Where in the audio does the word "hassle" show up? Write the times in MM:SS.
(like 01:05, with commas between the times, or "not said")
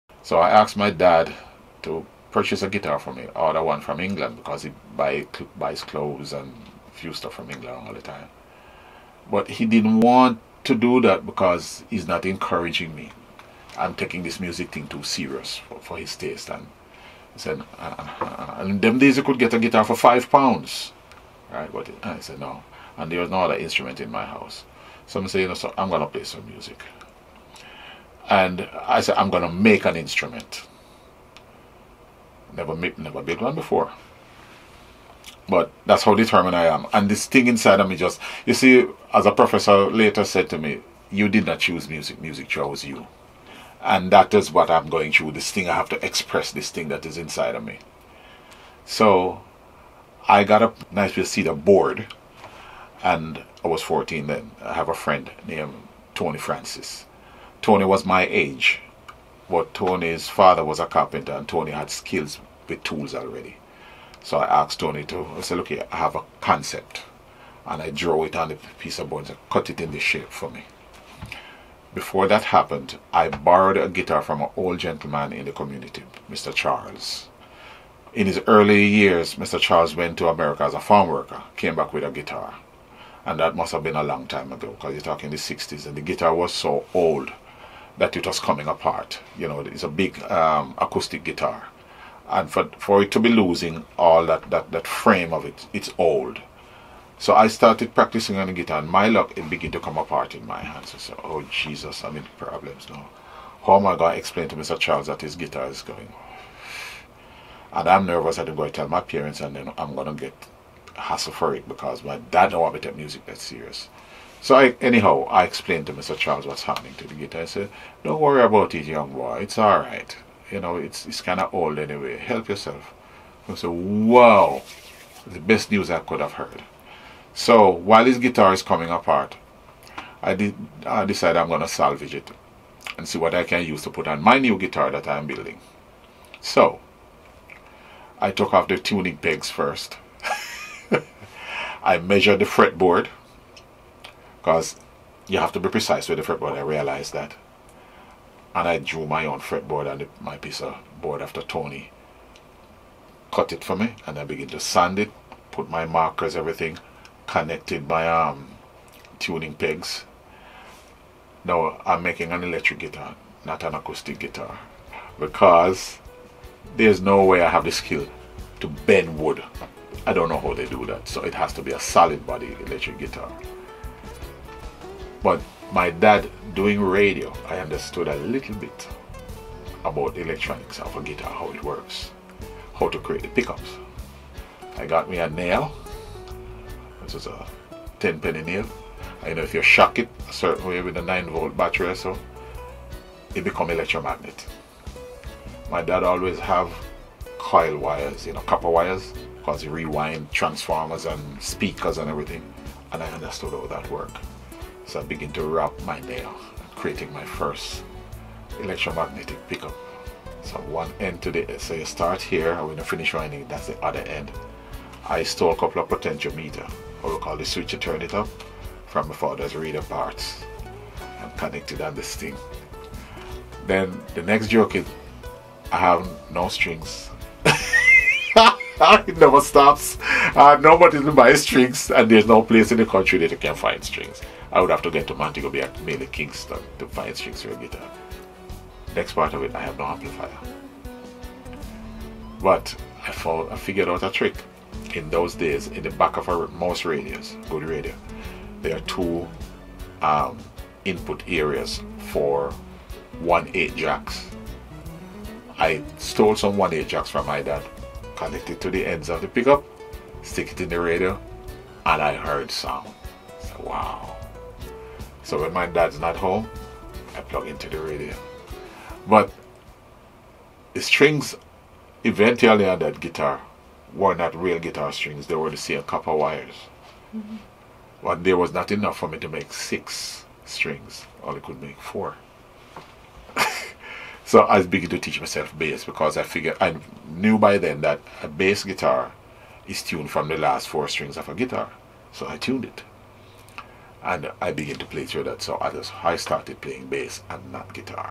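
01:50.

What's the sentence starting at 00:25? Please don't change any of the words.
So I'm saying, so I'm going to play some music.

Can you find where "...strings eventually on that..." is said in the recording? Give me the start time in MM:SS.
04:30.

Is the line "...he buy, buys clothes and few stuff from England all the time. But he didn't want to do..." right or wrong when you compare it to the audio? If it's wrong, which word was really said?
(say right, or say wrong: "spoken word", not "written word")
right.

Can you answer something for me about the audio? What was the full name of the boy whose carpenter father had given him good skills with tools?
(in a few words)
Tony Francis.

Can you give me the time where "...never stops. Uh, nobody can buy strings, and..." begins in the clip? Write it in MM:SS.
03:49.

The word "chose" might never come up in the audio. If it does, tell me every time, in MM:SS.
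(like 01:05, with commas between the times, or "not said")
00:42.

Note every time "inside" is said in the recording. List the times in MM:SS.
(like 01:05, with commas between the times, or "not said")
00:37, 00:47.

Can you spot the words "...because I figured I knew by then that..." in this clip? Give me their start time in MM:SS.
04:45.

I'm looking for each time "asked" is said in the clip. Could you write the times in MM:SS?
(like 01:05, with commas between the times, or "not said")
00:00, 01:04.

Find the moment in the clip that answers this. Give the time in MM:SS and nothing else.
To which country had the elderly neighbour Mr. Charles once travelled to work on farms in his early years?
01:20.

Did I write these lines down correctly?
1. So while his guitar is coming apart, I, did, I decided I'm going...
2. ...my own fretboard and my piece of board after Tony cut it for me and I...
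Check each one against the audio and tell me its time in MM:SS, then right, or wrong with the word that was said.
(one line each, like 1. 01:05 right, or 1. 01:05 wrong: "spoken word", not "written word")
1. 02:07 right
2. 02:29 right.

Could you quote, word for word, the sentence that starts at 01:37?
So I started practicing on the guitar, and my luck, it began to come apart in my hands.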